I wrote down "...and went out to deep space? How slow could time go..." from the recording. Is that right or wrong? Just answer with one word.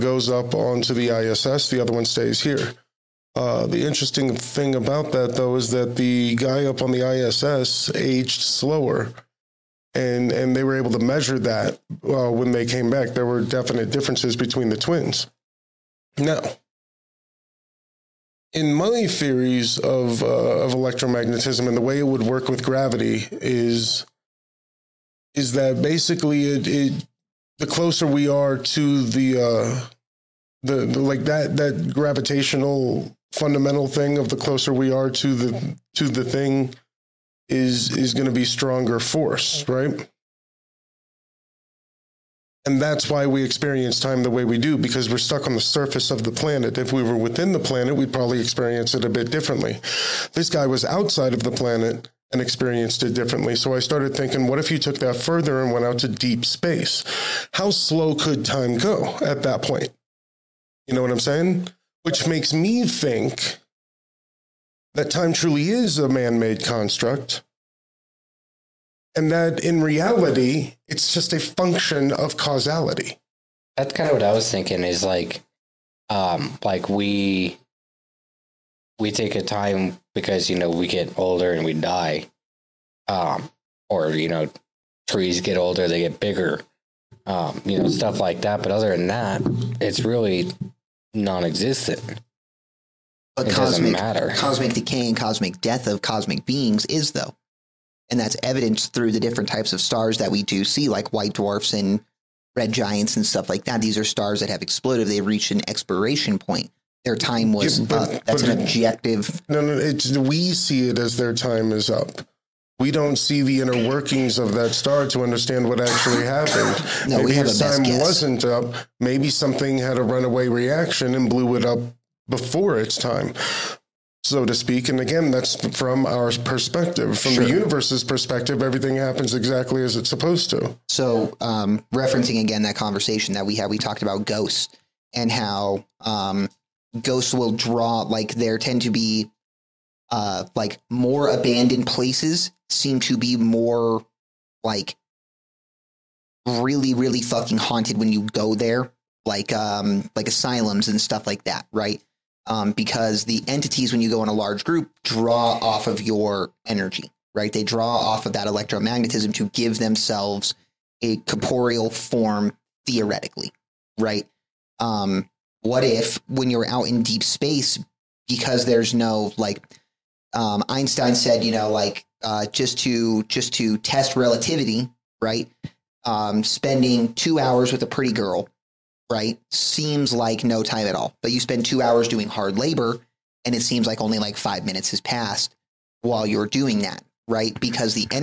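right.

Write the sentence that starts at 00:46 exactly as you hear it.
If we were within the planet, we'd probably experience it a bit differently.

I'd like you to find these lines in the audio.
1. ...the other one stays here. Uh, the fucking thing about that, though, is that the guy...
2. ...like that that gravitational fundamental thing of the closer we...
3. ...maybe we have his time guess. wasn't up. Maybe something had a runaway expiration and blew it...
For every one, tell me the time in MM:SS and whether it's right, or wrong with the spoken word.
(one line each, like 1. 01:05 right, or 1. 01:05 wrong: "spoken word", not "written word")
1. 00:01 wrong: "interesting", not "fucking"
2. 00:30 right
3. 01:57 wrong: "reaction", not "expiration".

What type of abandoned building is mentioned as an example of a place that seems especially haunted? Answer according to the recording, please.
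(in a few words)
Asylums.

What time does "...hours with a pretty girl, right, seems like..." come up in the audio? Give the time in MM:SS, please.
02:57.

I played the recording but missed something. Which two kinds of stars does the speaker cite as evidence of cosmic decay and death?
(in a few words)
White dwarfs and red giants.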